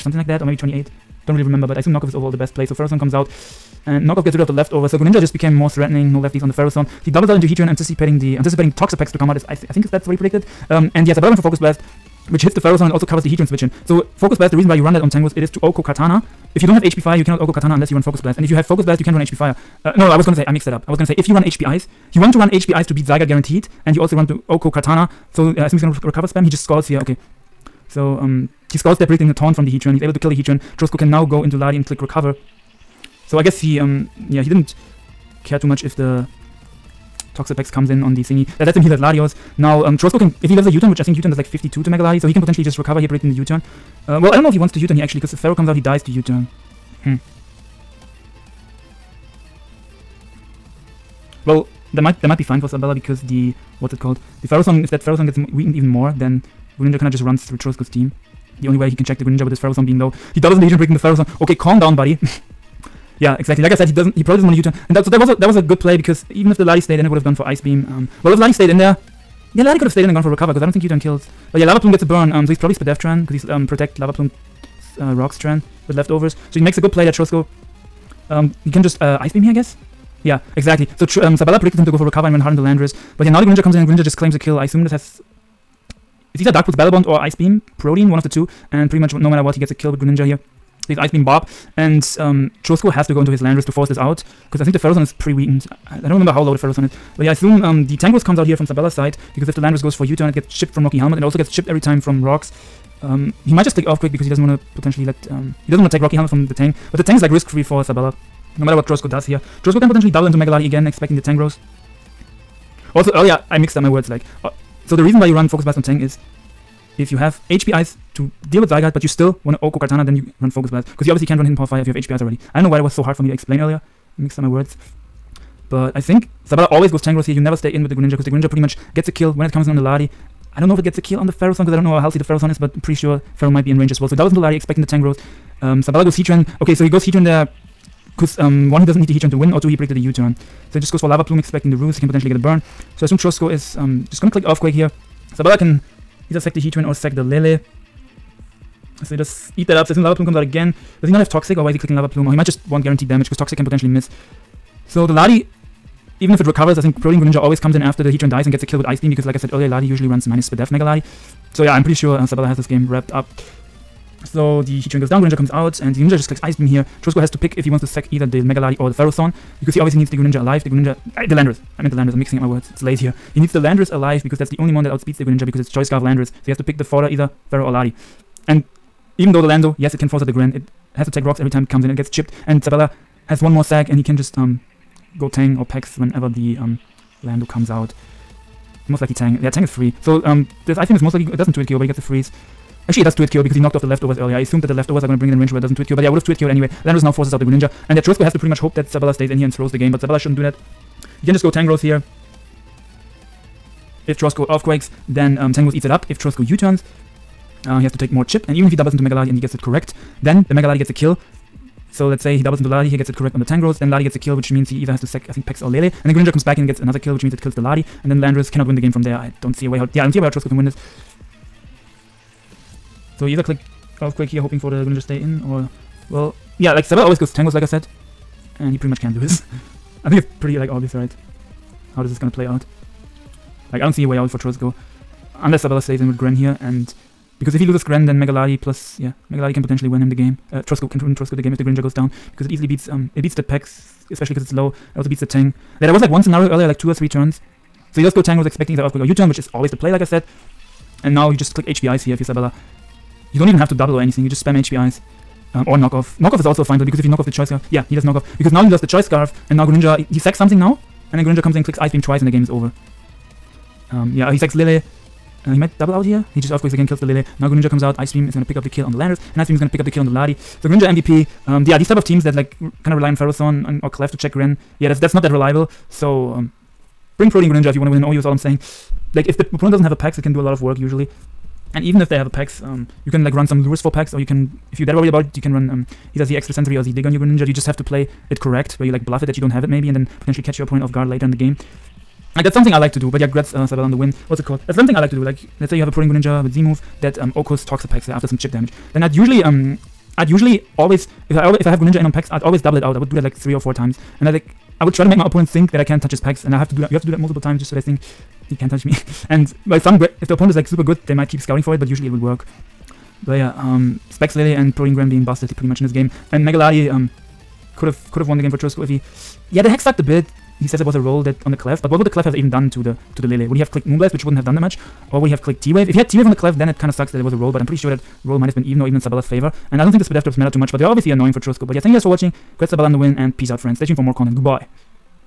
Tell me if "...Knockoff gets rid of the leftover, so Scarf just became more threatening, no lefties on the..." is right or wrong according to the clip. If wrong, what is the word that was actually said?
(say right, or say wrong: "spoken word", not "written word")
wrong: "Greninja", not "Scarf".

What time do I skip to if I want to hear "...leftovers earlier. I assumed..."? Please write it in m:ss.
3:13.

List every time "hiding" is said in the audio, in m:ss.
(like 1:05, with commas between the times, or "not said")
not said.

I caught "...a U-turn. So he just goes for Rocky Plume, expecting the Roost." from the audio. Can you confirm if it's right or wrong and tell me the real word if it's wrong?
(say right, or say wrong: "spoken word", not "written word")
wrong: "Lava", not "Rocky".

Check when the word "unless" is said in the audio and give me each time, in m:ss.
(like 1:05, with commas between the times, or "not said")
0:17, 3:55.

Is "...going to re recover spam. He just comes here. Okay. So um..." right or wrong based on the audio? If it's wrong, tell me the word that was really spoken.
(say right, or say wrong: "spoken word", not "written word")
wrong: "scores", not "comes".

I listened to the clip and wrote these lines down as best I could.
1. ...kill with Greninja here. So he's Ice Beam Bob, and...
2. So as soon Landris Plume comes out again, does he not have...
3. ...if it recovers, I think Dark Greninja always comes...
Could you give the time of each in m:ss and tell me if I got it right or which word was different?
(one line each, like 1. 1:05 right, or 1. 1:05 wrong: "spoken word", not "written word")
1. 1:29 right
2. 2:29 wrong: "Lava", not "Landris"
3. 2:36 wrong: "Protean", not "Dark".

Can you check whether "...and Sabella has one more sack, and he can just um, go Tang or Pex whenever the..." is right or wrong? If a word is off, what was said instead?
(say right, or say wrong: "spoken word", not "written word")
right.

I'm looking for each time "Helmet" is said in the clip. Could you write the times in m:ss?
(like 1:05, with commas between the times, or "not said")
1:40, 1:46.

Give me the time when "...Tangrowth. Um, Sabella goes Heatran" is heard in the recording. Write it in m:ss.
2:14.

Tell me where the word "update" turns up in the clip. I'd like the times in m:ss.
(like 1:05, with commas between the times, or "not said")
not said.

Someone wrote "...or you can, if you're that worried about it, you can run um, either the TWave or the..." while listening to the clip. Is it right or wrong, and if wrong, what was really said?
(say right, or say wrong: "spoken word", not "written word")
wrong: "Extrasensory", not "TWave".